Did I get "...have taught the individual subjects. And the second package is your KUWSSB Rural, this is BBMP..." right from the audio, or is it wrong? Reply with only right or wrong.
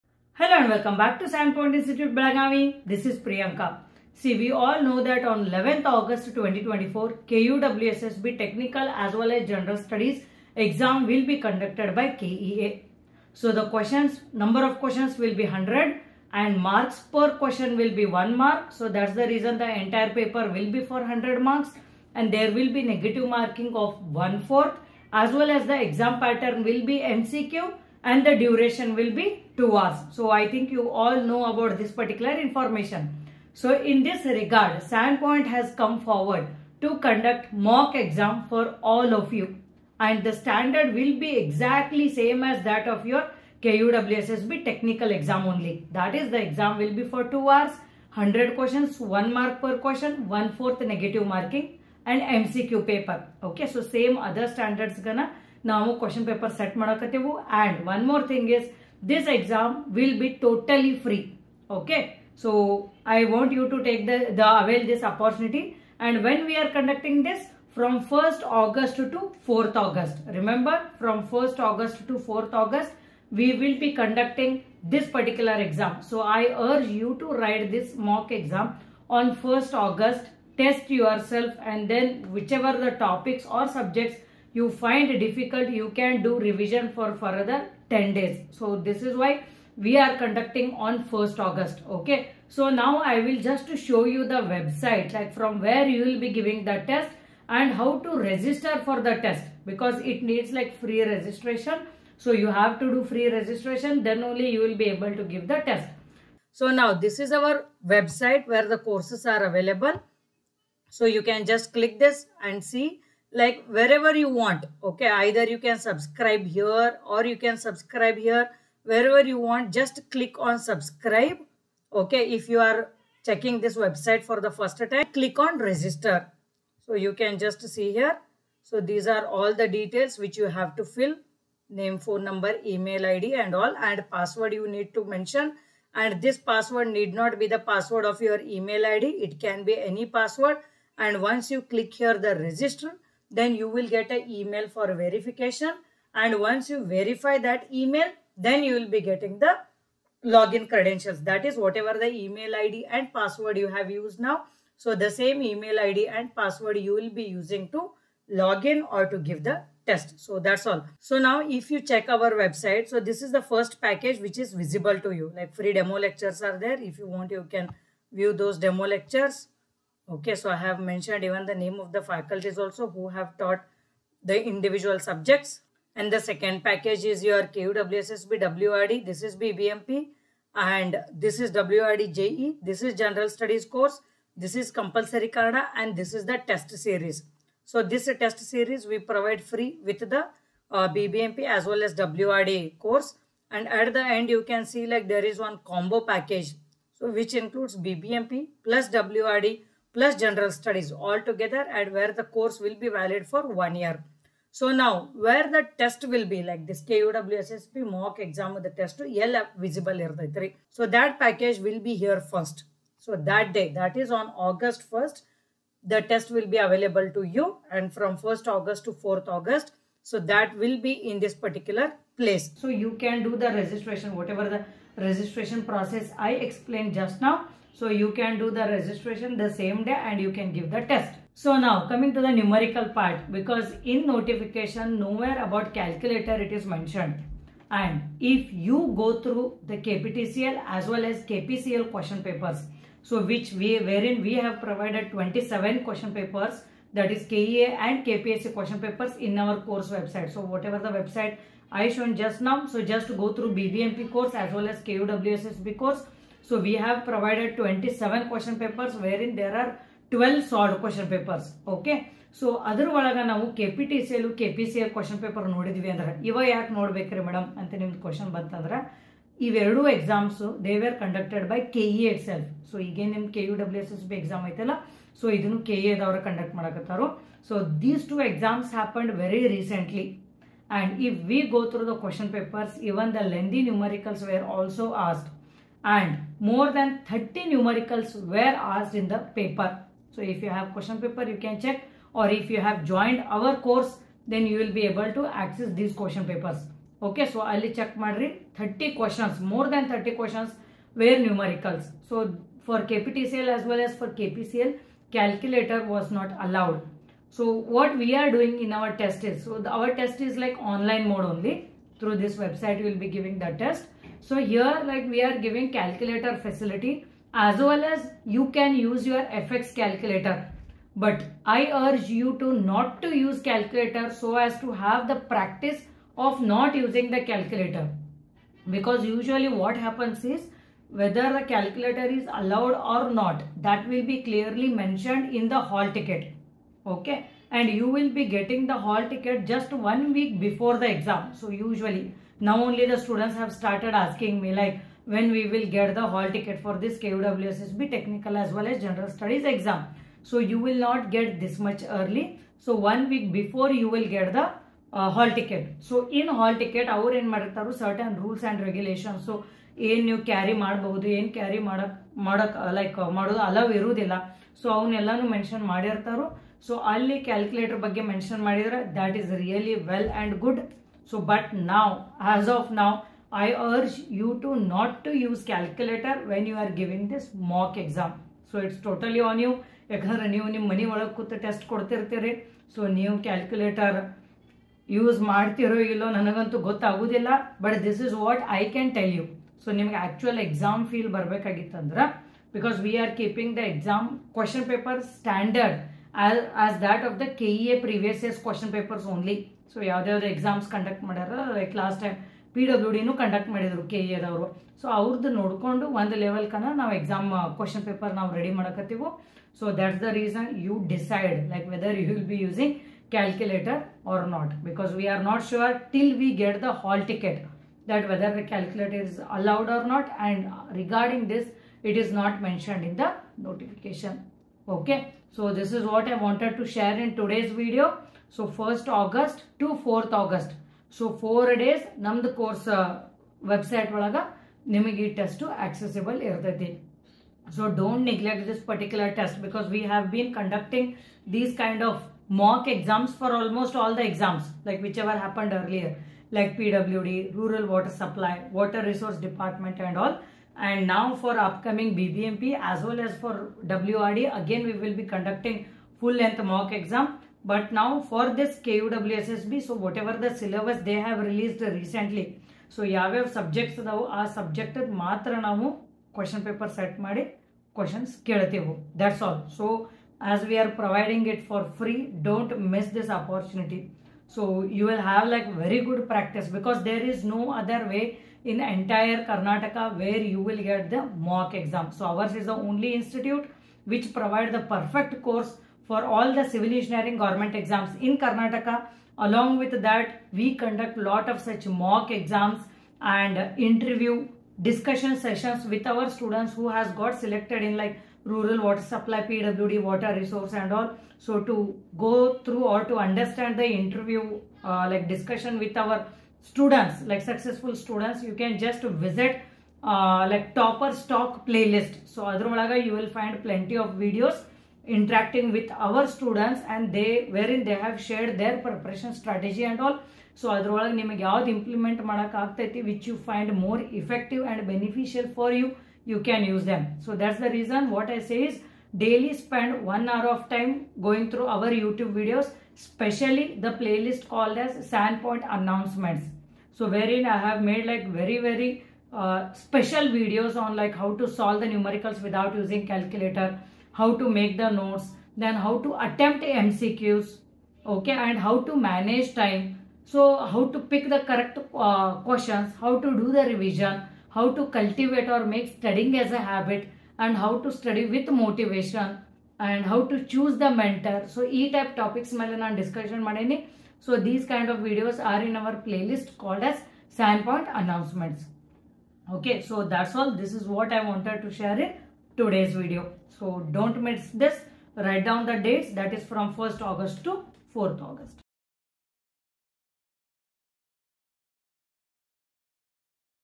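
wrong.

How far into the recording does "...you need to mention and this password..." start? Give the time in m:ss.
2:14.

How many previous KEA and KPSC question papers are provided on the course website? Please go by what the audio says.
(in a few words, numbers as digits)
27.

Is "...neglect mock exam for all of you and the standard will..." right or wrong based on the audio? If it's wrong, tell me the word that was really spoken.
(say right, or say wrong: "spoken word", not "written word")
wrong: "conduct", not "neglect".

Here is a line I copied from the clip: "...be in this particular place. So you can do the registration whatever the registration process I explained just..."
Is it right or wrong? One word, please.
right.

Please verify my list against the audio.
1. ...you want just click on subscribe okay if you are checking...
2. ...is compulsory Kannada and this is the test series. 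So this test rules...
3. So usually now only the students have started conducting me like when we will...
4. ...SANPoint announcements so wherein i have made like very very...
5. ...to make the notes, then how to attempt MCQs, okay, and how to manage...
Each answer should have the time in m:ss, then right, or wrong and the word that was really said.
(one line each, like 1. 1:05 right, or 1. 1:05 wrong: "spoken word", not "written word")
1. 1:59 right
2. 3:04 wrong: "series", not "rules"
3. 5:41 wrong: "asking", not "conducting"
4. 8:54 right
5. 9:04 right.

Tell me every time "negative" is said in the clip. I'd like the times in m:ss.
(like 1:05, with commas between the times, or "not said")
0:22, 0:50.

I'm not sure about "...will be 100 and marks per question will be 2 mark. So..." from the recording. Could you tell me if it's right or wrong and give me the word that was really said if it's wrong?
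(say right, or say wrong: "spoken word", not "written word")
wrong: "1", not "2".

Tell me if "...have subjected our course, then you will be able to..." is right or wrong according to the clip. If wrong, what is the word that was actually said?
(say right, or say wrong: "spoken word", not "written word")
wrong: "joined", not "subjected".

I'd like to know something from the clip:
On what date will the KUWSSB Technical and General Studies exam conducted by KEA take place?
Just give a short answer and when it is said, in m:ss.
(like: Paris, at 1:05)
11th August 2024, at 0:05.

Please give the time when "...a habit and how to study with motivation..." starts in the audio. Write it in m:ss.
9:16.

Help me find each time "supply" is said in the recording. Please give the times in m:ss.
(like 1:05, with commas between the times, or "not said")
7:27, 8:18.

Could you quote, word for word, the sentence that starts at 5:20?
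But I urge you to not to use calculator so as to have the practice of not using the calculator.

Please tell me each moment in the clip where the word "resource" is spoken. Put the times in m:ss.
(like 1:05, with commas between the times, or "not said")
7:28, 8:20.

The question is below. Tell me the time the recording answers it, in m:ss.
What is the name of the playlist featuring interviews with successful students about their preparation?
8:30.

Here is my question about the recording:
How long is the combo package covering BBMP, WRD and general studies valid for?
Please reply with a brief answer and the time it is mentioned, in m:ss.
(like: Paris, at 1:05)
One year, at 3:23.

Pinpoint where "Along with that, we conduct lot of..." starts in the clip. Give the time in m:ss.
8:09.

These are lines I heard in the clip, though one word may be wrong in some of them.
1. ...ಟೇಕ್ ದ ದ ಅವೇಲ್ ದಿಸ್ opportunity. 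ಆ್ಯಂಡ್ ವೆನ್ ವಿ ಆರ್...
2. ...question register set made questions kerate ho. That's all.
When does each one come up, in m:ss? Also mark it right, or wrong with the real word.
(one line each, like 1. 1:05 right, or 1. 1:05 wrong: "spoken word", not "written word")
1. 1:03 right
2. 7:46 wrong: "paper", not "register".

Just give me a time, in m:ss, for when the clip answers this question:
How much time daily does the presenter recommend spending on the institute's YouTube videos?
8:49.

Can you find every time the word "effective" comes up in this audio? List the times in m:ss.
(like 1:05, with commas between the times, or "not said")
8:44.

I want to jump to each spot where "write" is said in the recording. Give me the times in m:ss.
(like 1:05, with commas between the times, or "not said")
1:17, 9:34.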